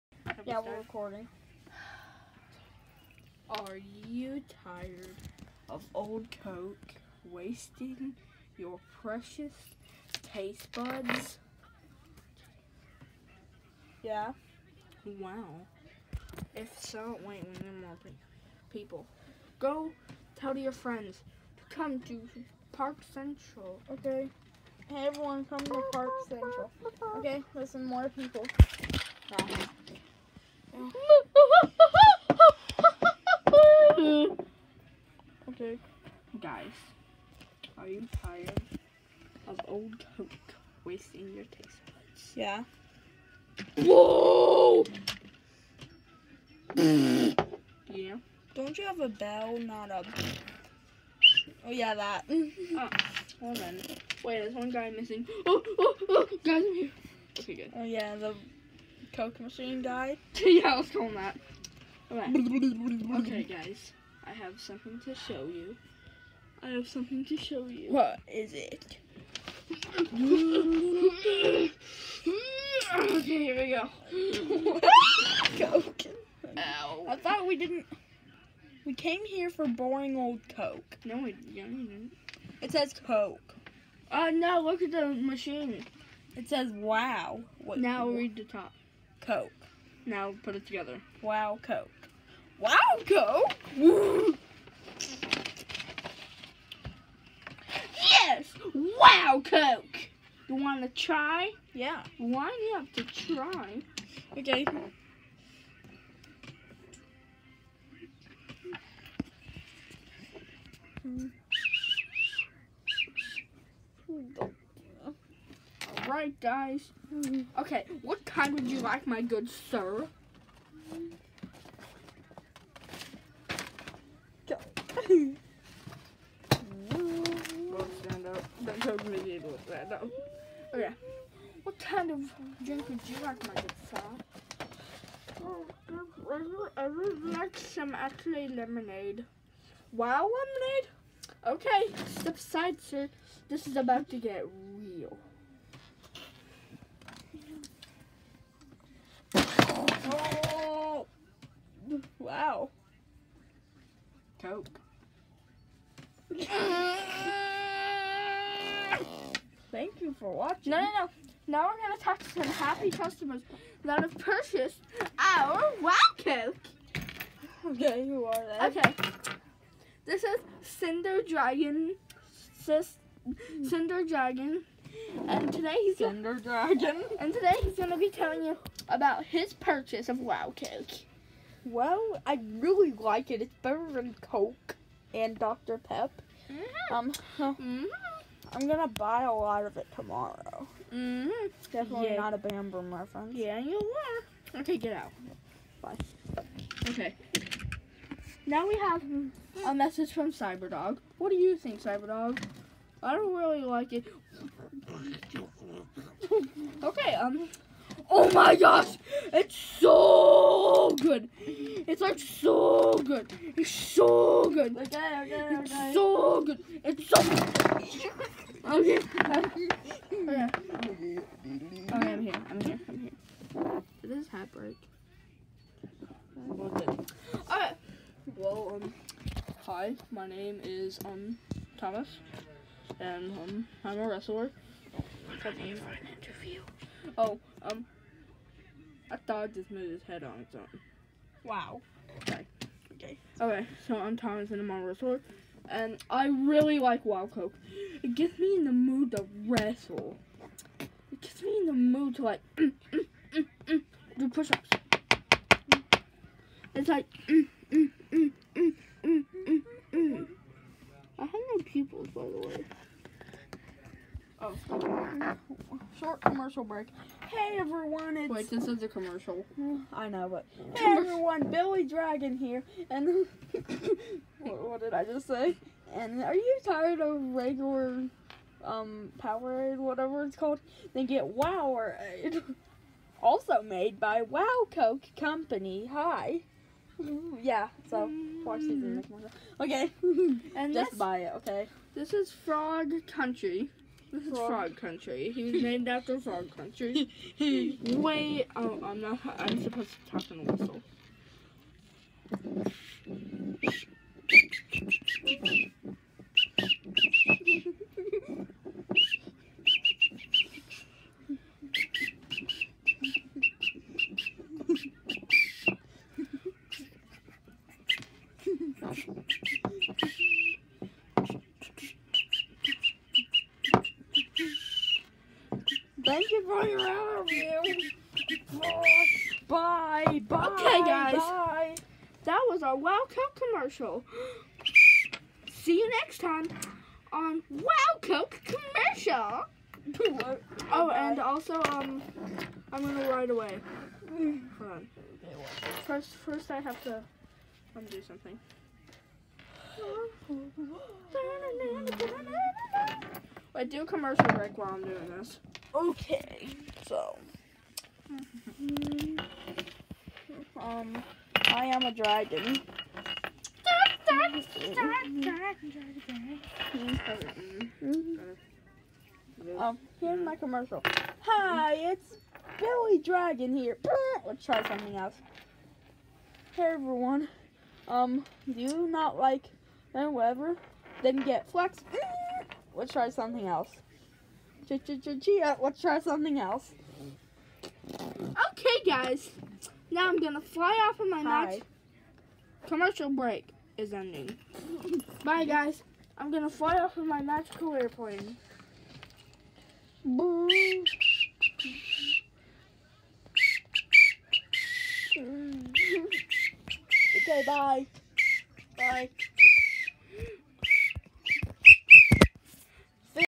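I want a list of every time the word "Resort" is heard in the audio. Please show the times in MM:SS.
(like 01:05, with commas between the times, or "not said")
04:04.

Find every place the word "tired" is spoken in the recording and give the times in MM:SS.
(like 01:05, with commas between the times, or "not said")
00:04, 00:38, 04:36.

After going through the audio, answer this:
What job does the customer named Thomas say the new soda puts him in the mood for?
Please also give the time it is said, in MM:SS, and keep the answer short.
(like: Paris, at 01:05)
wrestler, at 03:54.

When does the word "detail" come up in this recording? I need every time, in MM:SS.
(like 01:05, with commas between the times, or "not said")
not said.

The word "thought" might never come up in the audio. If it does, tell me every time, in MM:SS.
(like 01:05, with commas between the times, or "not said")
01:17, 03:59.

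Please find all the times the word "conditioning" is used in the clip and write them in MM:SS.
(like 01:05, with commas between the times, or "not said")
not said.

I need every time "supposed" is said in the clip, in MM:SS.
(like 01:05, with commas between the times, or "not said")
04:59.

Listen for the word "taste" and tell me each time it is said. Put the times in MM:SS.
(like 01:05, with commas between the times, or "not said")
00:10, 00:41.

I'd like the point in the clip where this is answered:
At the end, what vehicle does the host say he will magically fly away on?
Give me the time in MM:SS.
06:37.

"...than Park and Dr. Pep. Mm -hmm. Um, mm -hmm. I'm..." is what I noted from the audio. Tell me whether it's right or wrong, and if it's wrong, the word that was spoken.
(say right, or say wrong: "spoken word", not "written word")
wrong: "Coke", not "Park".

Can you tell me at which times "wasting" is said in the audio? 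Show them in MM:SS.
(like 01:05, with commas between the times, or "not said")
00:07, 00:40.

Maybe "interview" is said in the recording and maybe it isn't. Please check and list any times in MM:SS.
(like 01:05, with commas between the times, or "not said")
03:56, 05:26.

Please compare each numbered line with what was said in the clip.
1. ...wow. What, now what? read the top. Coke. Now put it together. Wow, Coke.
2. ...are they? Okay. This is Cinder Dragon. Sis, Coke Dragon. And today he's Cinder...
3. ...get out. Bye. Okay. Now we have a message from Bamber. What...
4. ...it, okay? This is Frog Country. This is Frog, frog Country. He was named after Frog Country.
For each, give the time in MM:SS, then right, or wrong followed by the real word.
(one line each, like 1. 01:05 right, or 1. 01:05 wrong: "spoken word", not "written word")
1. 01:26 right
2. 02:48 wrong: "Cinder", not "Coke"
3. 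03:14 wrong: "Cyberdog", not "Bamber"
4. 04:51 right.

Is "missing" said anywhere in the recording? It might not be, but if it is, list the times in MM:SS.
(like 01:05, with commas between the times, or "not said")
00:54.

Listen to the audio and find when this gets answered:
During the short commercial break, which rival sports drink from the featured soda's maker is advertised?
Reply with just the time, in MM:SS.
04:41.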